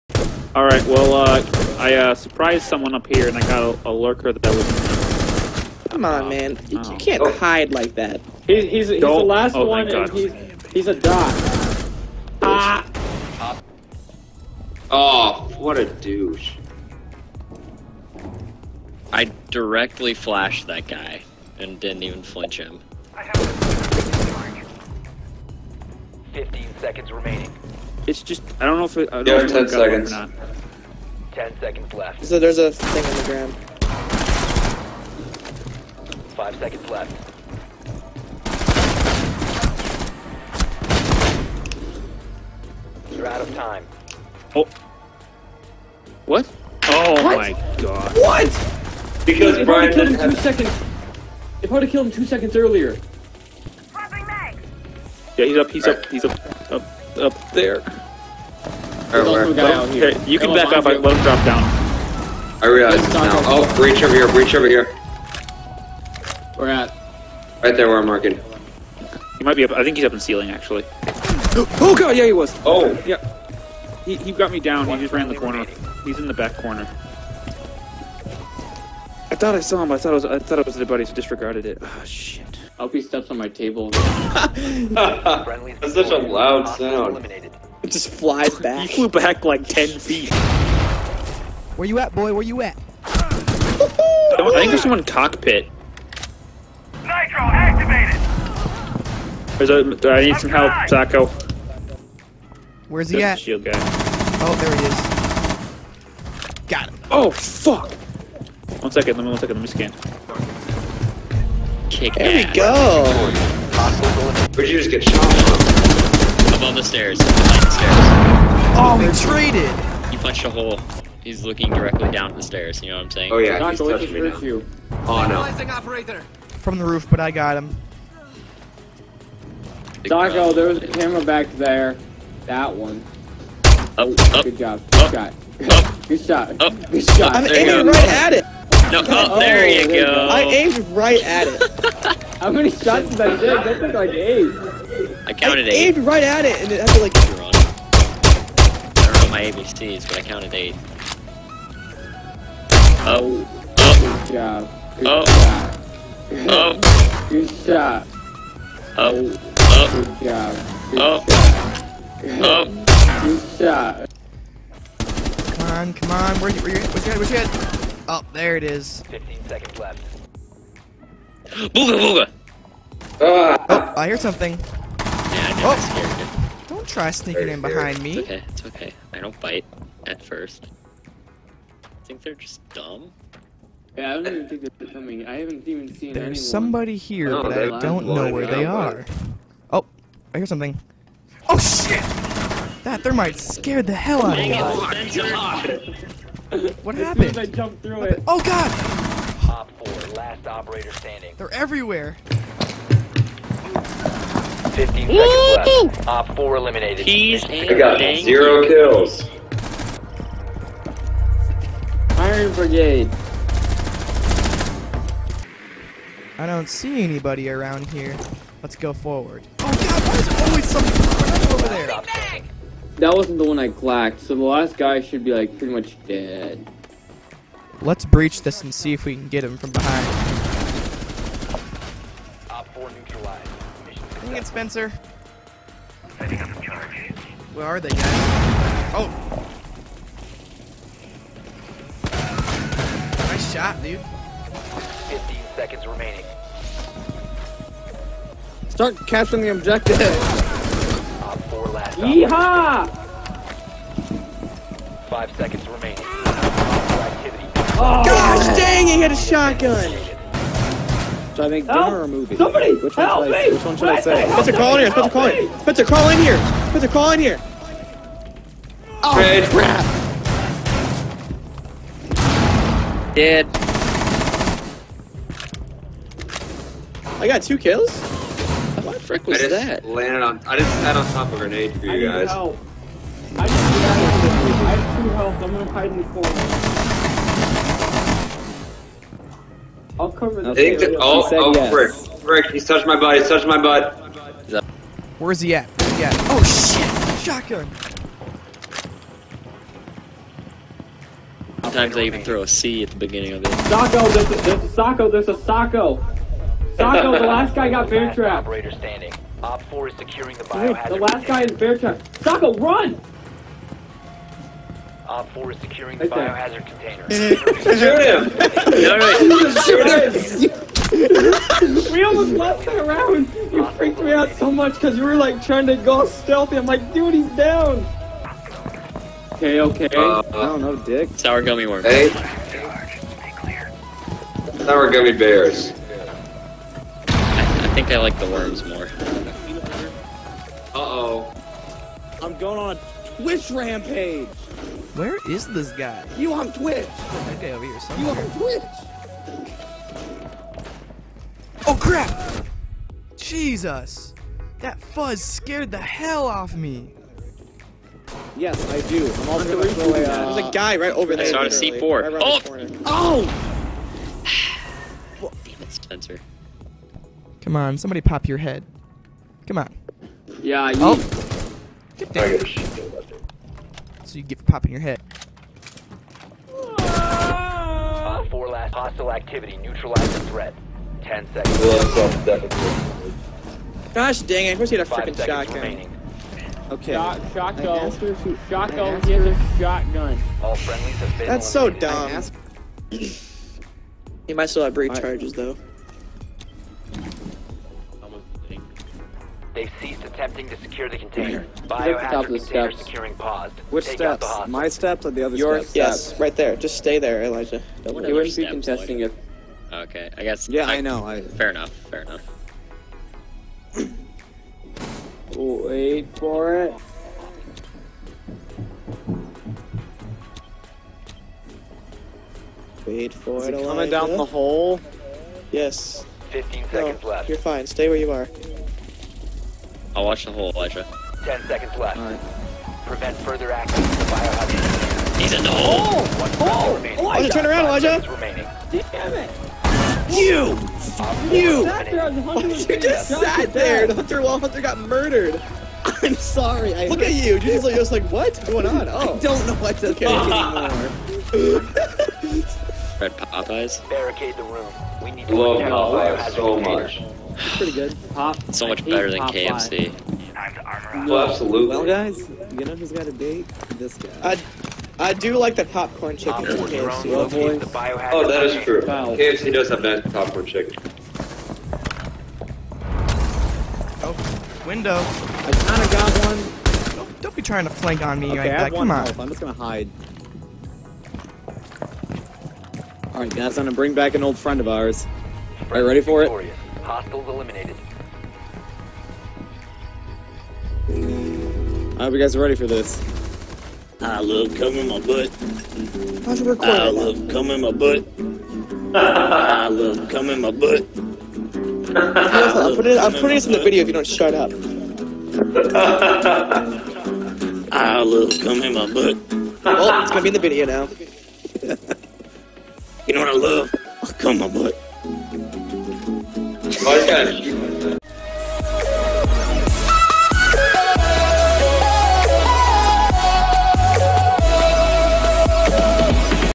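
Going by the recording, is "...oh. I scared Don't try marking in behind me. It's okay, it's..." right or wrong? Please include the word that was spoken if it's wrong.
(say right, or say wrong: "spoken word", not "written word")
wrong: "sneaking", not "marking".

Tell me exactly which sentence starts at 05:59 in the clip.
I'm all gonna uh, There's a guy right over there.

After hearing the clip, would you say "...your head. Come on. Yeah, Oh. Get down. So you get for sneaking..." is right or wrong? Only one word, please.
wrong.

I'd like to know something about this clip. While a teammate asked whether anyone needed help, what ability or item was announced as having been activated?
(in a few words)
Nitro.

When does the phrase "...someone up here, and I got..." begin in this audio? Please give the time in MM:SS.
00:02.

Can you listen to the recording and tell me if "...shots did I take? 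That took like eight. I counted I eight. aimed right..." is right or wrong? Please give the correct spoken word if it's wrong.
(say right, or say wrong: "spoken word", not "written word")
right.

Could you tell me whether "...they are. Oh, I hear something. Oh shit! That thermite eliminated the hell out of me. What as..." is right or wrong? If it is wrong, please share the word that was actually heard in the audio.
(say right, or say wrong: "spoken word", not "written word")
wrong: "scared", not "eliminated".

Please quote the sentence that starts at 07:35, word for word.
We need to Love Popeyes so much.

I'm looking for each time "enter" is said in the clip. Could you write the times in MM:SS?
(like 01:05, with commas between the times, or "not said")
not said.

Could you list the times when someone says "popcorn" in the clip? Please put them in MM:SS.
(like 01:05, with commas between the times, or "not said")
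07:45, 07:50.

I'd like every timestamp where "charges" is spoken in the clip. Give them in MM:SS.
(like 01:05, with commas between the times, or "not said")
06:34.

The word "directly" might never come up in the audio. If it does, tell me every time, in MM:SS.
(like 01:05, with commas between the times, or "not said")
00:19, 02:01.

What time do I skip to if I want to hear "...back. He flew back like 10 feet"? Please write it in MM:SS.
01:28.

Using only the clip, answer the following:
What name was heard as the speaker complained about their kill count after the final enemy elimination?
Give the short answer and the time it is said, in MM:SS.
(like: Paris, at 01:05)
Iron Brigade, at 03:32.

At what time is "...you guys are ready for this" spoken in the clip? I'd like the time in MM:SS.
08:12.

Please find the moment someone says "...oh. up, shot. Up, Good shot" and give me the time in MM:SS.
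02:15.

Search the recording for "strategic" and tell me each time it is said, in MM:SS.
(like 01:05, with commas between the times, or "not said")
not said.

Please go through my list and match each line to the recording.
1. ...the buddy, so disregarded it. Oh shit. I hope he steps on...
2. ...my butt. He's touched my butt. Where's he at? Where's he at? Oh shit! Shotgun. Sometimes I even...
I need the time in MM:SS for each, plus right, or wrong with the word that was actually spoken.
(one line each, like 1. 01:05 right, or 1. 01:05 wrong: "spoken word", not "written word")
1. 01:20 right
2. 04:52 right.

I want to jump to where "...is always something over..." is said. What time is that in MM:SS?
03:40.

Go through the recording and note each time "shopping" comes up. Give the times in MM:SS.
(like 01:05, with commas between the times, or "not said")
not said.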